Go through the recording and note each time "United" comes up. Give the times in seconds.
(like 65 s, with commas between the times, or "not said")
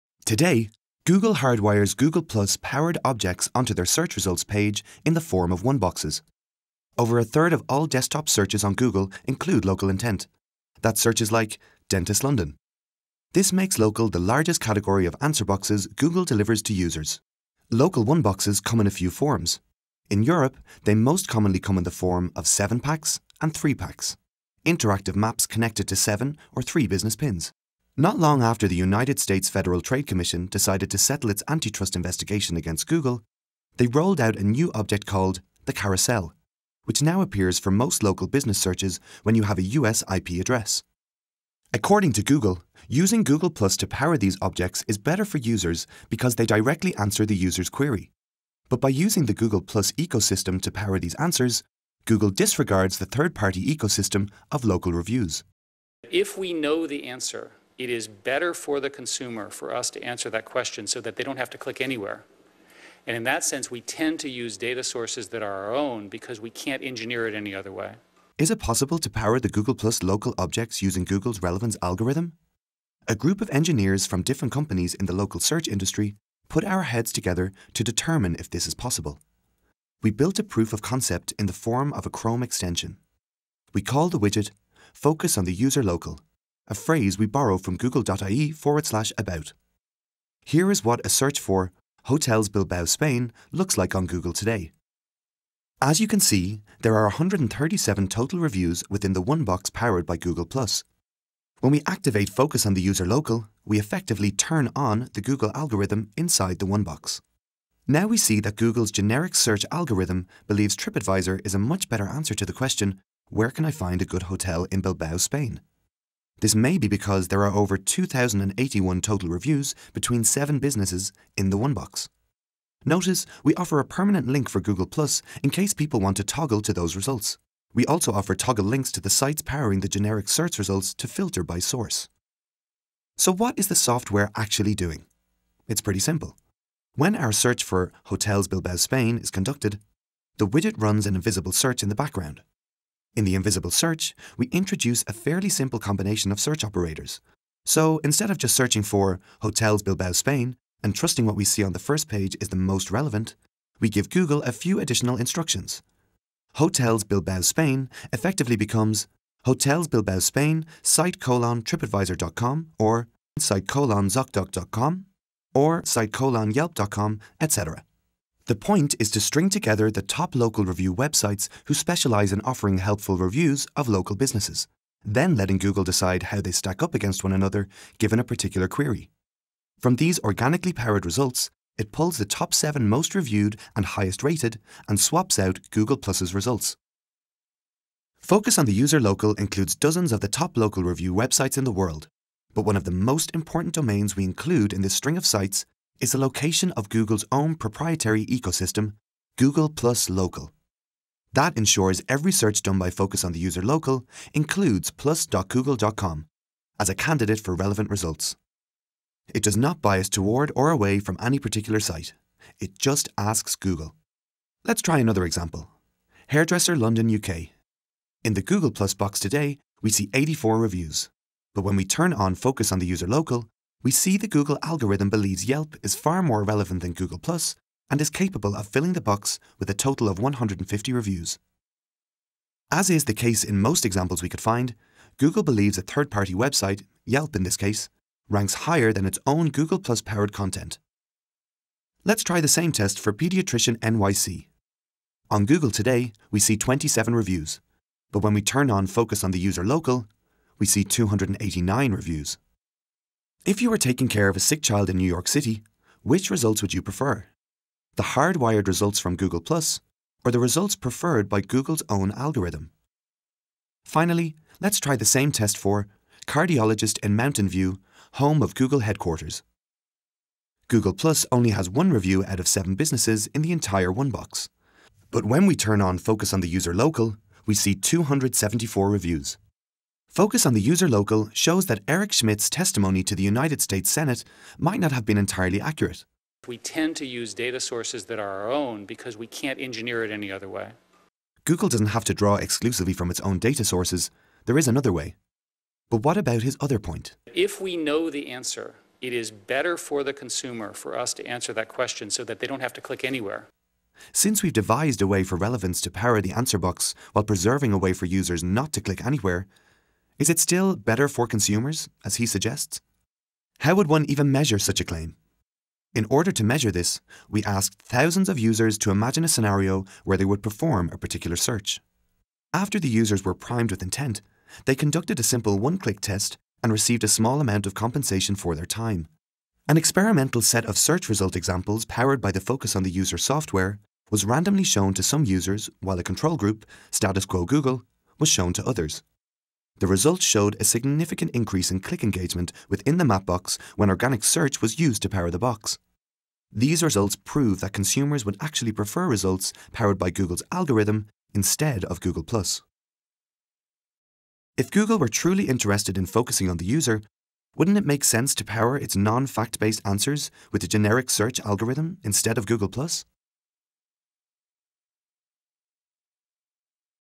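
28 s, 283 s.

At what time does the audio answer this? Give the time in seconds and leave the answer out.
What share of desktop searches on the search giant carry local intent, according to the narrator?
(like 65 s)
6 s.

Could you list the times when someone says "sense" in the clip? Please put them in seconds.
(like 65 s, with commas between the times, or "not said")
63 s, 358 s.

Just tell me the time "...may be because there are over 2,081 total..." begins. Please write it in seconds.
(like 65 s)
116 s.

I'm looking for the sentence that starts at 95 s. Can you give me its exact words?
As you can see, there are 137 total reviews within the one box powered by Google+.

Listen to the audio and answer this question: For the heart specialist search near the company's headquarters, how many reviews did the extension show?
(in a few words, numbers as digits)
274.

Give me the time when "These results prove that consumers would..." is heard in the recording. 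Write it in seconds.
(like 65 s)
346 s.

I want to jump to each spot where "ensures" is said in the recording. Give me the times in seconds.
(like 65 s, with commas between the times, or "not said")
201 s.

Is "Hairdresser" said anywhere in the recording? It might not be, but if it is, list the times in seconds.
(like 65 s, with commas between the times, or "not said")
216 s.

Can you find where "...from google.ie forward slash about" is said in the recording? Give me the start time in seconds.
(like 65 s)
87 s.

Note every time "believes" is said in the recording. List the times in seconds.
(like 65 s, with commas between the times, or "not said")
110 s, 225 s, 235 s.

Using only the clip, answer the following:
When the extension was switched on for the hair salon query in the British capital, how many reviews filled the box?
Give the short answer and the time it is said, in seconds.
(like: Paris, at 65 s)
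150, at 230 s.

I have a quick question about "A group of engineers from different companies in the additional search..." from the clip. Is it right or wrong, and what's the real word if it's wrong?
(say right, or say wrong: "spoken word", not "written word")
wrong: "local", not "additional".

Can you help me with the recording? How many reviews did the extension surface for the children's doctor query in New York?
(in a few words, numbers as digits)
289.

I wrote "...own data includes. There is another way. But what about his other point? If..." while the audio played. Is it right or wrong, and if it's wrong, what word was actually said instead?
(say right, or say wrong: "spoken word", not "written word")
wrong: "sources", not "includes".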